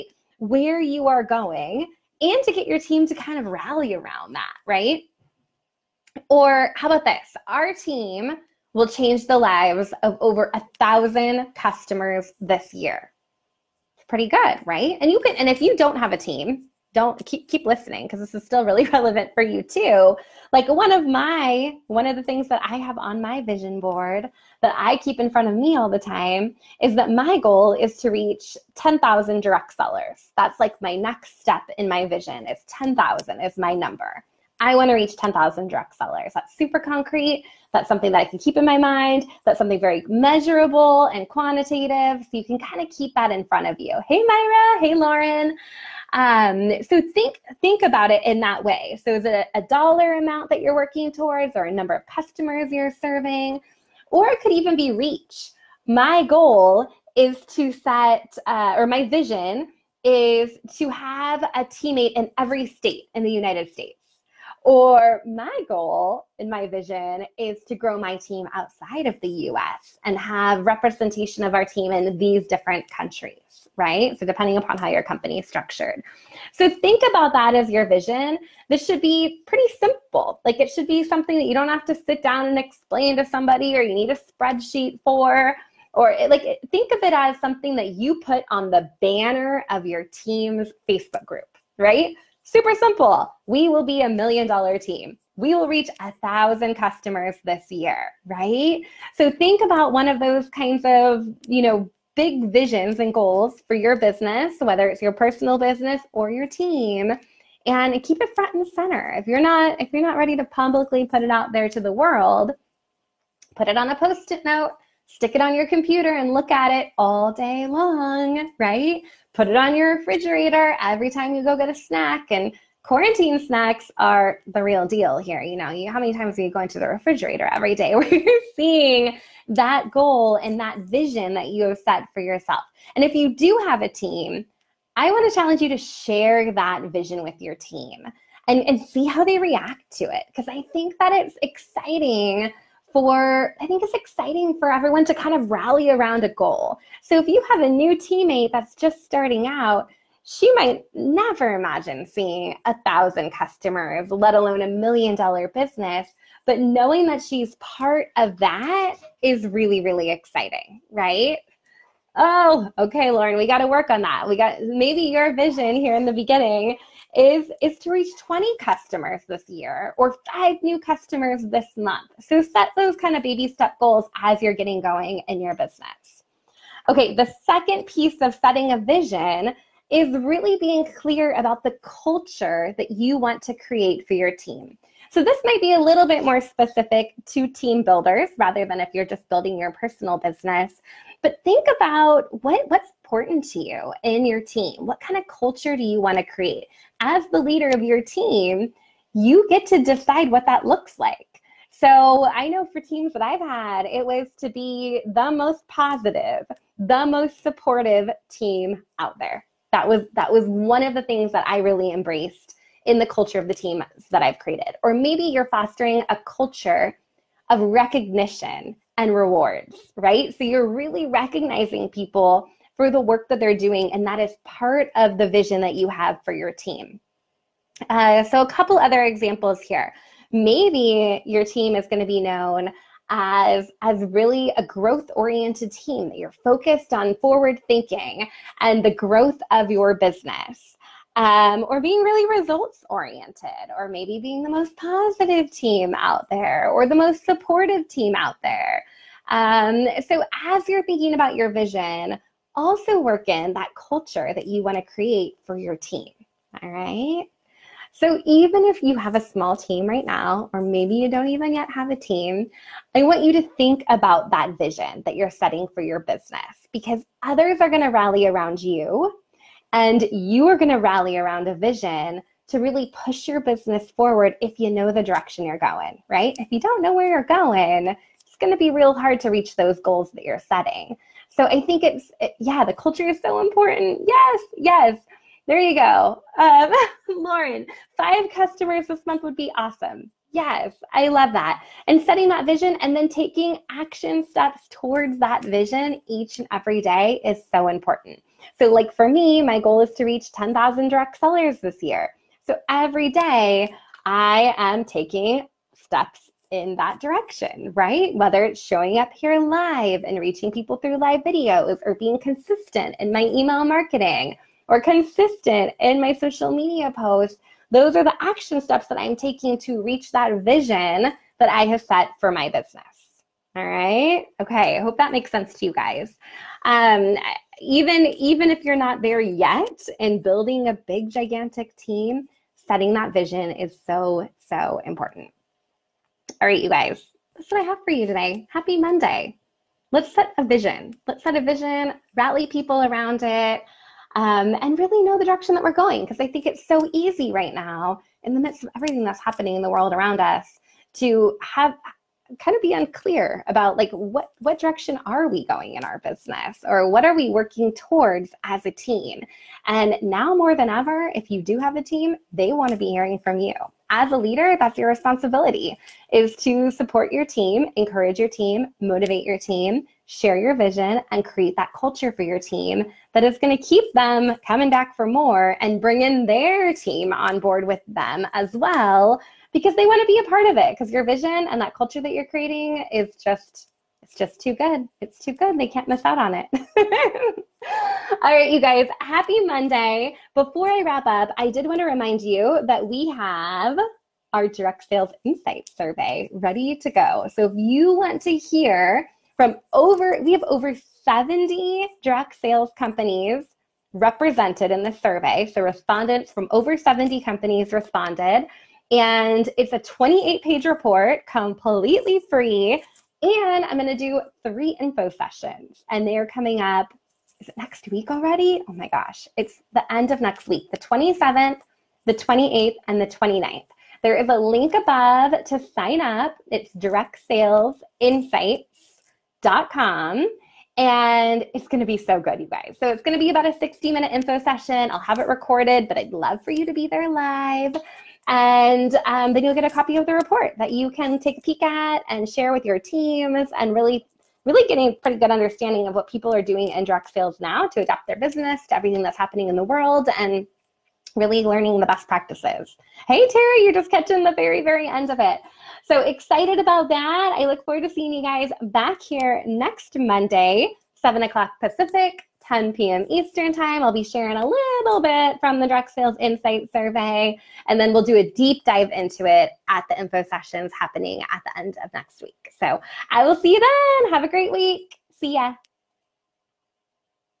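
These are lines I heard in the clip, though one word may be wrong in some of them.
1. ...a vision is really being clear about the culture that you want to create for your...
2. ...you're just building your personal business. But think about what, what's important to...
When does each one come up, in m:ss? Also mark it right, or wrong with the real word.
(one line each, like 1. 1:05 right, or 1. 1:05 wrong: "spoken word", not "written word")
1. 2:58 right
2. 3:08 right.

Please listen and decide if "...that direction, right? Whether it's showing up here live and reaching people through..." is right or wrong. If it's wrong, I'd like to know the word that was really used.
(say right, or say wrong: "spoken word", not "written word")
right.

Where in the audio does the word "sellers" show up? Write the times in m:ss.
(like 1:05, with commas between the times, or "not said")
0:29, 0:35, 5:01.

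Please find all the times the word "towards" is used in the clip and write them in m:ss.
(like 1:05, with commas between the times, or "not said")
0:51, 4:54, 5:57.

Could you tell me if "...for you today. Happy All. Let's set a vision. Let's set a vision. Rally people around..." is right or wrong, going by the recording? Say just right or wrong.
wrong.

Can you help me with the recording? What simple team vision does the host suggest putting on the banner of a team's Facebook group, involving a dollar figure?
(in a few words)
a million dollar team.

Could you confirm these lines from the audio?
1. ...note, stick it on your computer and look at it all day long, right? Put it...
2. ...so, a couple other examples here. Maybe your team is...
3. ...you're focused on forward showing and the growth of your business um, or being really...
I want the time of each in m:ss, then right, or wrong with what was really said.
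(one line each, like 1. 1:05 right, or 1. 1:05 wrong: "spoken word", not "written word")
1. 1:54 right
2. 3:48 right
3. 3:56 wrong: "thinking", not "showing".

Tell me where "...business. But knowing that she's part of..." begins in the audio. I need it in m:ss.
2:35.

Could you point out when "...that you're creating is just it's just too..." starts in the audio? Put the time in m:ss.
6:22.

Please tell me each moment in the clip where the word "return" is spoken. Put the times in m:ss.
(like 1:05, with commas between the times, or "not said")
not said.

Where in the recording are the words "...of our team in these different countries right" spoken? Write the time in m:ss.
1:11.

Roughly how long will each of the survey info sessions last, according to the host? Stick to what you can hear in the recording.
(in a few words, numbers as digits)
60 minutes.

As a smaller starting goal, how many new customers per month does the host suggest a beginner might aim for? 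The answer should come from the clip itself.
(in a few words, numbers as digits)
5.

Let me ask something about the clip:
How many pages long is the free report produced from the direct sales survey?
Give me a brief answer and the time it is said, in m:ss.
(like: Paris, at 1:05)
28, at 6:49.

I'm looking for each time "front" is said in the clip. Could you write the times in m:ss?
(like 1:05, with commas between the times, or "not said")
0:25, 0:43, 1:48.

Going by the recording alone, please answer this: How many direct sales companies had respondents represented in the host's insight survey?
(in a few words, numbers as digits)
over 70.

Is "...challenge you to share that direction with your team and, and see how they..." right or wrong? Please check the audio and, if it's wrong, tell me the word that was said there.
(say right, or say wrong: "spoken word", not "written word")
wrong: "vision", not "direction".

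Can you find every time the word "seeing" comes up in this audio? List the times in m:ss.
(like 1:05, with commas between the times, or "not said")
2:08, 2:32, 7:37.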